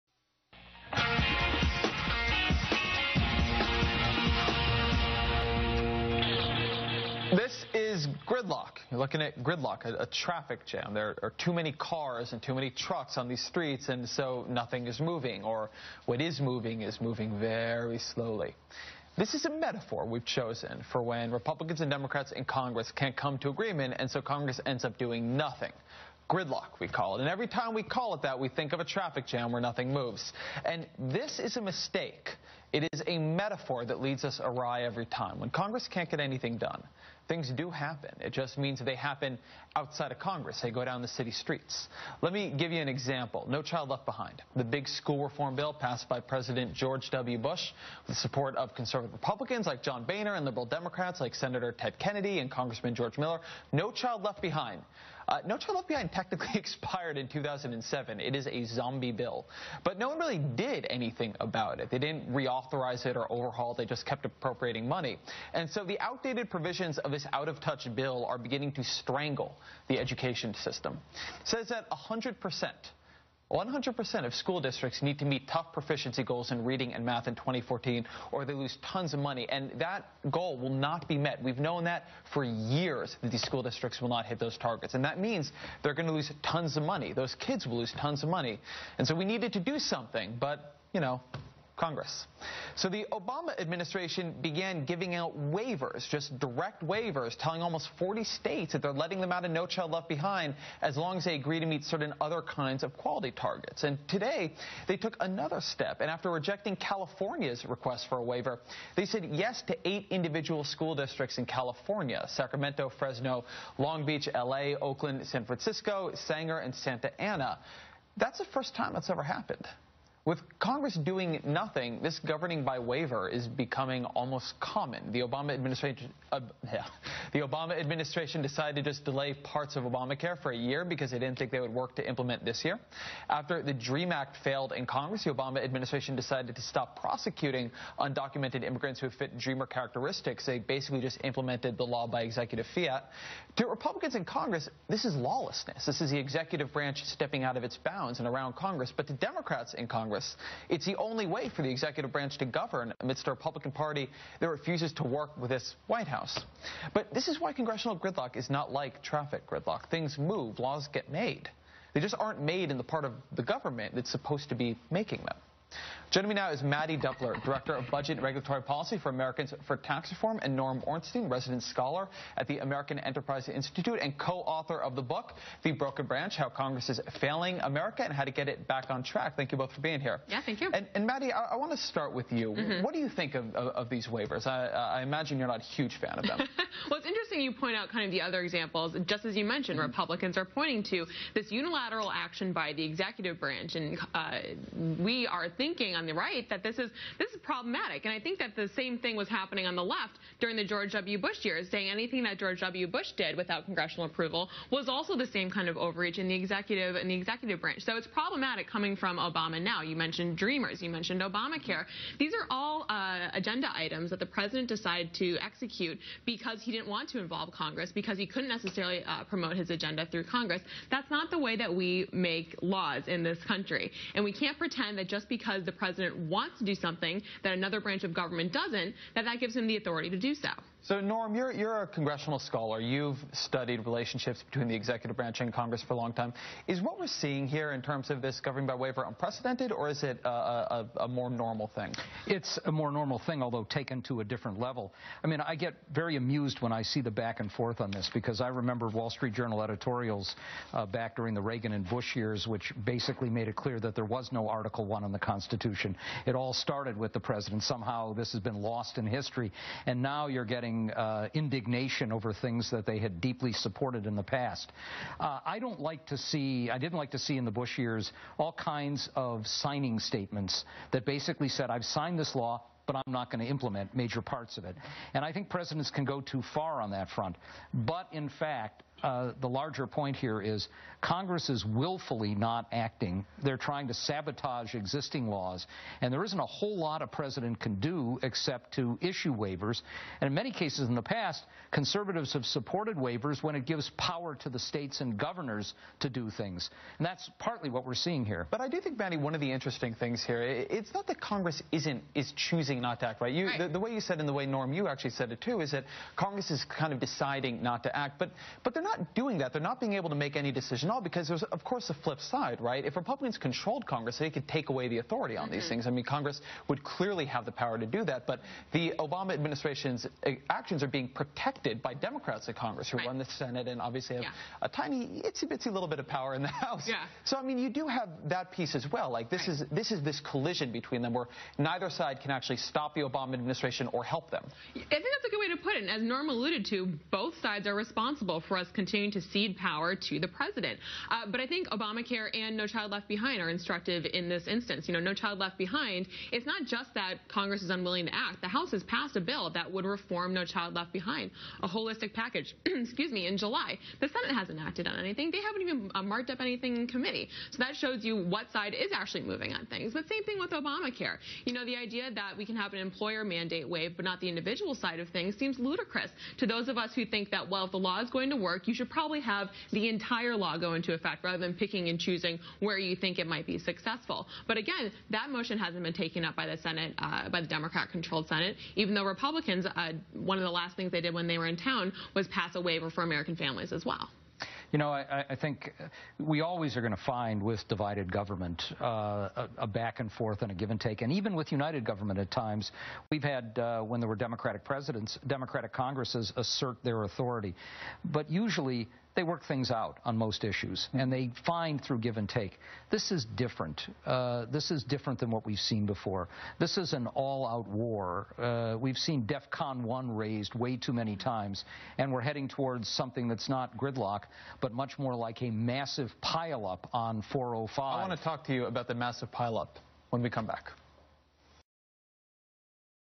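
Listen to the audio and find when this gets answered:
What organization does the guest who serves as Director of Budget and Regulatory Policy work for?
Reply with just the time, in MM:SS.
02:49.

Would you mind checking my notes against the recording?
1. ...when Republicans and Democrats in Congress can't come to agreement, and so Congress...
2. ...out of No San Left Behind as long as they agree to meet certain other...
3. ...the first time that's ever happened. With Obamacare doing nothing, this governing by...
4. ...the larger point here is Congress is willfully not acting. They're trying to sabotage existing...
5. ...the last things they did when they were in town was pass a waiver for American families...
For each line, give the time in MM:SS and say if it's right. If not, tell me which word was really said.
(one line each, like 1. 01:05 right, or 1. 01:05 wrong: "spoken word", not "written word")
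1. 00:21 right
2. 01:39 wrong: "Child", not "San"
3. 01:58 wrong: "Congress", not "Obamacare"
4. 04:39 right
5. 06:20 right.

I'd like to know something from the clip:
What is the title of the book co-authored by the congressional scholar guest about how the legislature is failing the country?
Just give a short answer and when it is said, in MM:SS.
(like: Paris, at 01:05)
The Broken Branch, at 02:55.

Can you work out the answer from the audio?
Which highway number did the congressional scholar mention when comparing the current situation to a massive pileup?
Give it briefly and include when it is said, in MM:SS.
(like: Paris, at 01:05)
405, at 06:57.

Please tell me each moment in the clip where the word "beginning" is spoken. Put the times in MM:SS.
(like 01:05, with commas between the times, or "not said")
01:08.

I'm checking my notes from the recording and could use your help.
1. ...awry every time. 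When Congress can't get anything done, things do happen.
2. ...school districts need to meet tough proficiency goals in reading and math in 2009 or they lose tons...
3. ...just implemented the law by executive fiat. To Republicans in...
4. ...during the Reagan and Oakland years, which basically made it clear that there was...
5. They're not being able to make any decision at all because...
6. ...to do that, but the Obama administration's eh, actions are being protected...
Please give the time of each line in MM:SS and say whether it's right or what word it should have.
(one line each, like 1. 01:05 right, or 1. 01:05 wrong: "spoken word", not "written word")
1. 00:34 right
2. 01:14 wrong: "2014", not "2009"
3. 02:21 right
4. 04:11 wrong: "Bush", not "Oakland"
5. 05:09 right
6. 05:17 right.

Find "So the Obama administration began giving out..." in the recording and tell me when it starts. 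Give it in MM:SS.
01:32.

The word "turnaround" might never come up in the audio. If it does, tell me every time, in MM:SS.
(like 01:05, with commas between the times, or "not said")
not said.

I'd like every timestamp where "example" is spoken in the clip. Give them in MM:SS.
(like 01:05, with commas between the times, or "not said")
00:42, 03:08.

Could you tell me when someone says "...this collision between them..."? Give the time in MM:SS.
05:30.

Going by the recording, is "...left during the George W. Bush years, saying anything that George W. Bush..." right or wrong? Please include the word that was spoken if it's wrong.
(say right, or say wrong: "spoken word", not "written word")
right.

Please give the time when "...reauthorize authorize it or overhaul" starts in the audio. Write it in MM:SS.
01:02.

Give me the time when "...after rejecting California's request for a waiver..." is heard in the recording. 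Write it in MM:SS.
01:46.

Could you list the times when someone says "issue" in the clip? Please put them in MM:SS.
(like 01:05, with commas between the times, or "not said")
04:49, 06:40.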